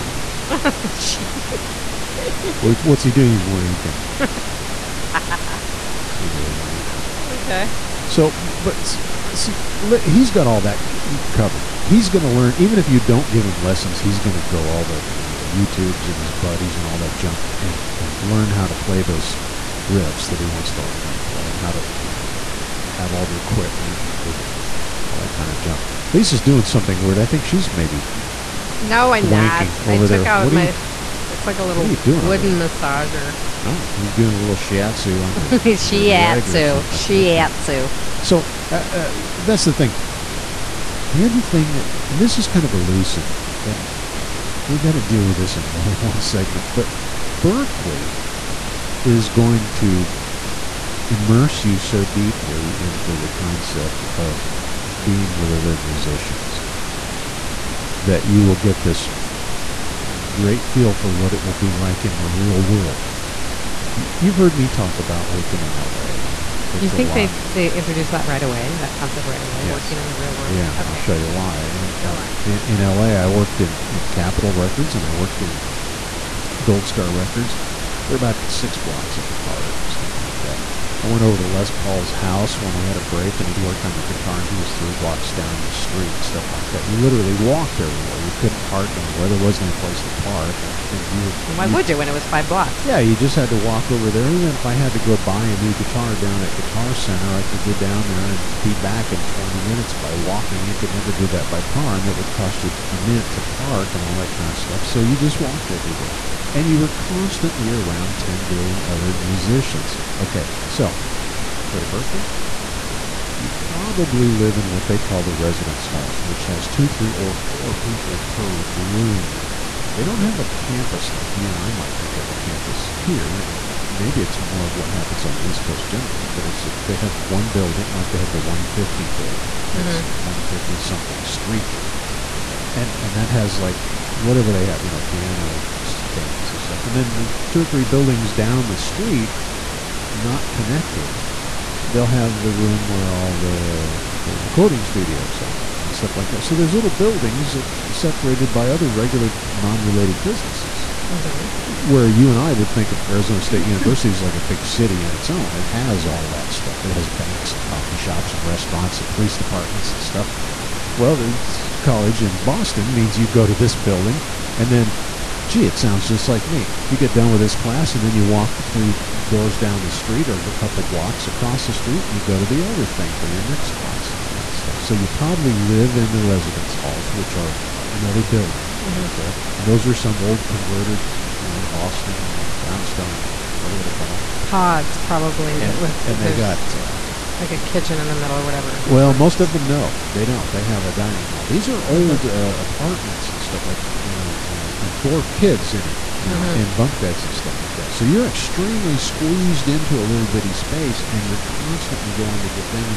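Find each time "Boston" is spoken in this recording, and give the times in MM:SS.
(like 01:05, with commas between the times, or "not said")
02:42, 03:01.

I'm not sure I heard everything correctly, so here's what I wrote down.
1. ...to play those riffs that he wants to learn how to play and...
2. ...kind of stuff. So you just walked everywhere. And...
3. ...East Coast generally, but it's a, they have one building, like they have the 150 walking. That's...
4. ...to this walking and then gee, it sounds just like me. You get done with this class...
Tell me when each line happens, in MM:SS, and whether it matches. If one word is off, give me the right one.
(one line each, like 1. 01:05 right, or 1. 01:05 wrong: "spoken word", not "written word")
1. 00:18 right
2. 01:44 right
3. 02:05 wrong: "building", not "walking"
4. 02:43 wrong: "building", not "walking".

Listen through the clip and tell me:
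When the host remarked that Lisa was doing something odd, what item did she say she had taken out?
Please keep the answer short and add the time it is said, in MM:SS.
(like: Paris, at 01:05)
wooden massager, at 00:31.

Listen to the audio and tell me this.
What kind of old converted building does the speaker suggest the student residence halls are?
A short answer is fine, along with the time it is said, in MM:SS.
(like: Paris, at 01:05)
brownstone, at 03:02.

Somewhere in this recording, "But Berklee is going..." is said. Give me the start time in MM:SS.
00:46.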